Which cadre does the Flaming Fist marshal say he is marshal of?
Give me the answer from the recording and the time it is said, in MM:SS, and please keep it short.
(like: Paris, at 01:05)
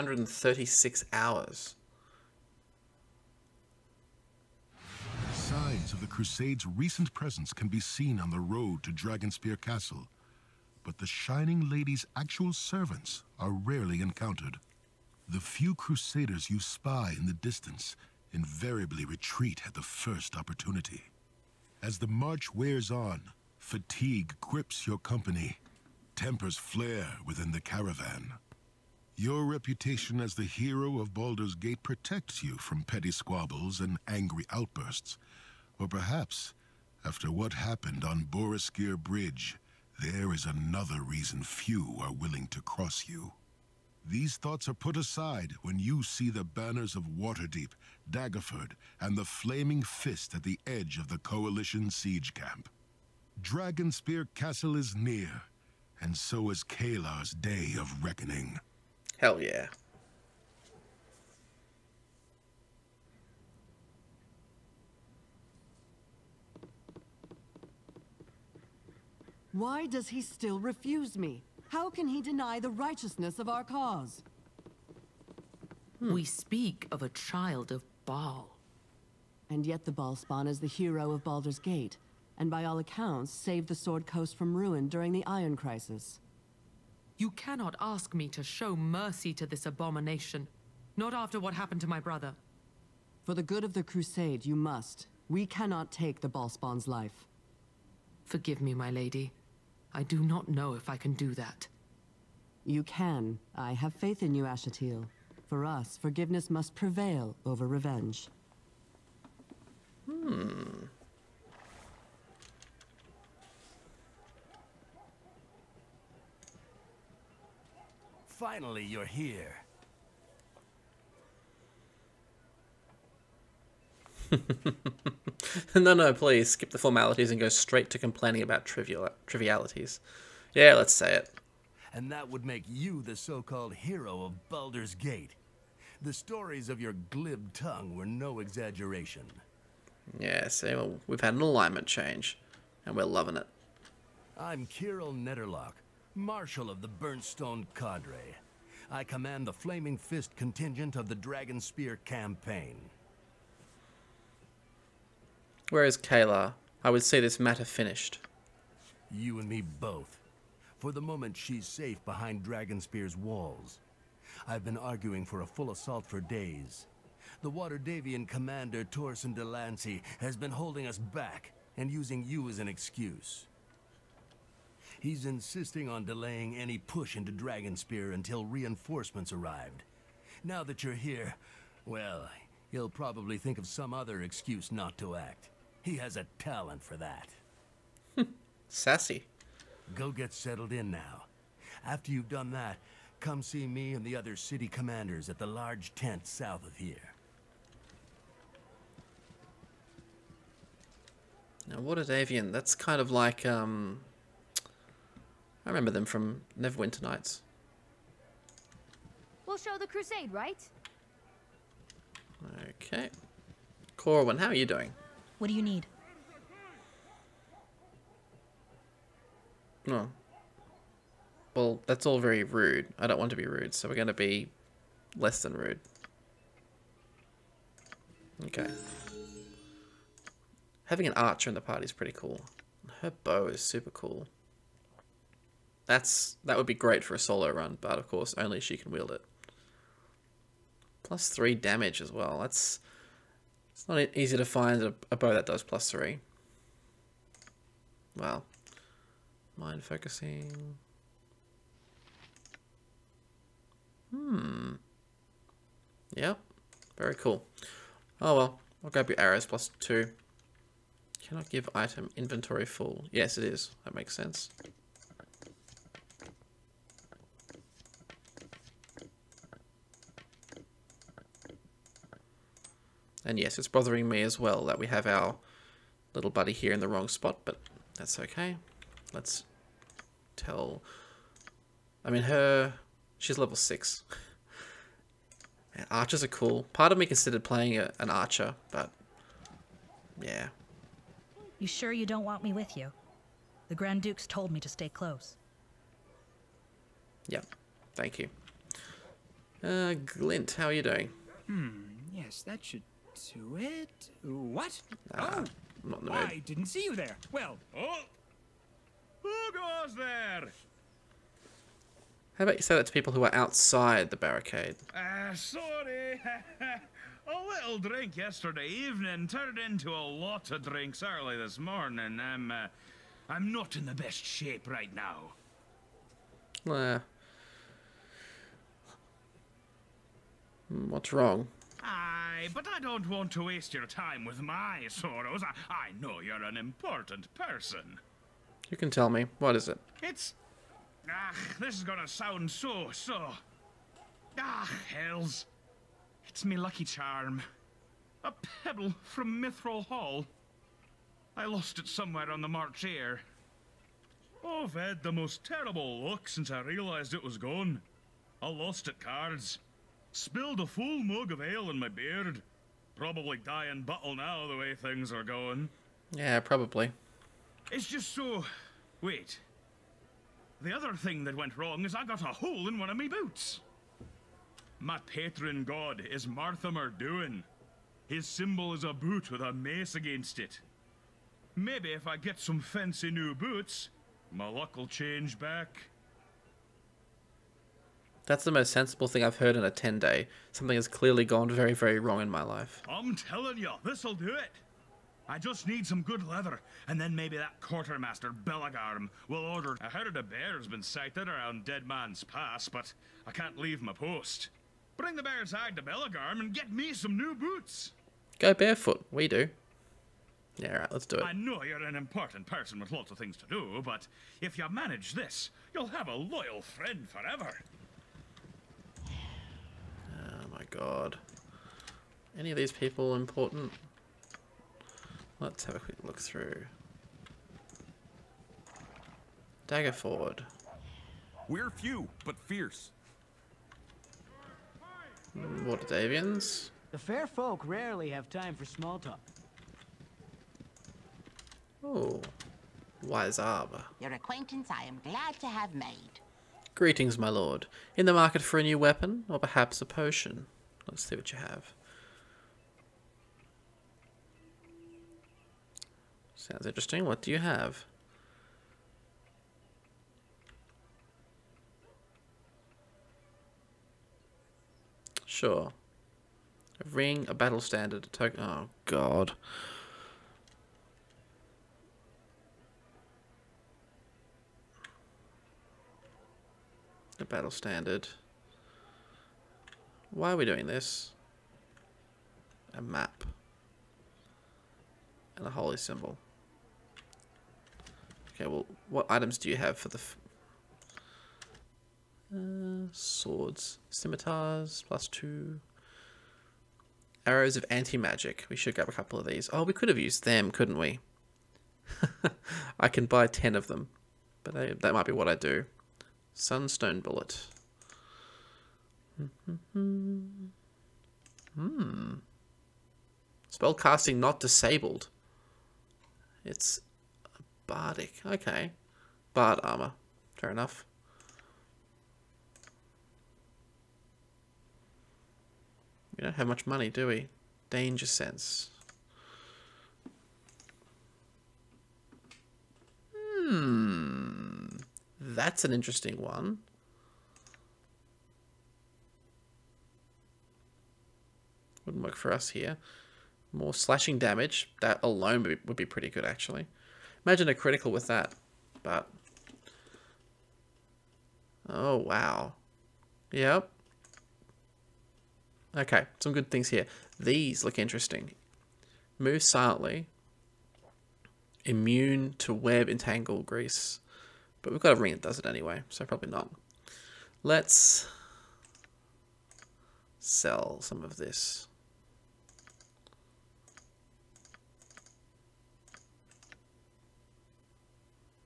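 Burnstone Cadre, at 02:26.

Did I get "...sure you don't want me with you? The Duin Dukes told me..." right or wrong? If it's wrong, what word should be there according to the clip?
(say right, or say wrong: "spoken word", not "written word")
wrong: "Grand", not "Duin".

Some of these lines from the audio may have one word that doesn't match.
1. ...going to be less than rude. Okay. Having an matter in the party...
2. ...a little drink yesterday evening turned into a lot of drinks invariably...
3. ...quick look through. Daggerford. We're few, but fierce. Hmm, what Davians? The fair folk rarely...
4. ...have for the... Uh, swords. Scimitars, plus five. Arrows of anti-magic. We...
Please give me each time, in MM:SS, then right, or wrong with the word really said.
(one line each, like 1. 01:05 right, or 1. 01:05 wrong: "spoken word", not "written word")
1. 03:43 wrong: "archer", not "matter"
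2. 05:17 wrong: "early", not "invariably"
3. 07:05 right
4. 08:09 wrong: "two", not "five".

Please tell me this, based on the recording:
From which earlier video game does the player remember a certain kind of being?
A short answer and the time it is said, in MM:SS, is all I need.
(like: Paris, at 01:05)
Neverwinter Nights, at 03:26.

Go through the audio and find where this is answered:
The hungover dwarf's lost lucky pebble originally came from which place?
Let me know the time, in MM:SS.
05:49.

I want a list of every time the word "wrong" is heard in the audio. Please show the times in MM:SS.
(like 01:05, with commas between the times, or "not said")
04:36, 05:31, 06:11, 06:31.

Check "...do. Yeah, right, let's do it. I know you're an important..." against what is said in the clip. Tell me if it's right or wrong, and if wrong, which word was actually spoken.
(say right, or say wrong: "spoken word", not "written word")
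right.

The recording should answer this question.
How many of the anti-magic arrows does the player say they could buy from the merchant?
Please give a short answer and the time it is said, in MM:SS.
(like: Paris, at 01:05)
10, at 08:23.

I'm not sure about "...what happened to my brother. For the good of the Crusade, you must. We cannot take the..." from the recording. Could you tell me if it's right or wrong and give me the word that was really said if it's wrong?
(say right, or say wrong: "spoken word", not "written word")
right.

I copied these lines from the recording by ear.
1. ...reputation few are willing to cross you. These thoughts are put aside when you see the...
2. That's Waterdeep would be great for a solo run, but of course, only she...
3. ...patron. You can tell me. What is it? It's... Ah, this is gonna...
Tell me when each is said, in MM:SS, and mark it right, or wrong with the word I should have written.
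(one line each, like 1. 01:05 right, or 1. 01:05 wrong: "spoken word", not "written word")
1. 00:41 wrong: "reason", not "reputation"
2. 03:55 wrong: "That", not "Waterdeep"
3. 05:37 wrong: "person", not "patron".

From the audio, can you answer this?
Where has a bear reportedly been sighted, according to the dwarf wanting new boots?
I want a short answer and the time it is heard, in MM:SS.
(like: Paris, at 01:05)
Dead Man's Pass, at 06:41.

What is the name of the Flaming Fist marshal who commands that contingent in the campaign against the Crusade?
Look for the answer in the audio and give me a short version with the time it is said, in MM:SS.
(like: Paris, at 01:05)
Kirill Netterlock, at 02:24.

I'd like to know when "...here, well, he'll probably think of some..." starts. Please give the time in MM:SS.
03:00.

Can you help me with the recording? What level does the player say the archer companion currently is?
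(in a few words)
6.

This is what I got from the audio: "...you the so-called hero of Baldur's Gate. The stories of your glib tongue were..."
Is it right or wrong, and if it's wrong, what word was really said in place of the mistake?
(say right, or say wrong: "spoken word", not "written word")
right.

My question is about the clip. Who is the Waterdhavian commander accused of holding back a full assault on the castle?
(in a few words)
Torsen Delancey.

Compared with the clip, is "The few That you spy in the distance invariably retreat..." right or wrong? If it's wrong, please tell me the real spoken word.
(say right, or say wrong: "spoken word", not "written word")
wrong: "Crusaders", not "That".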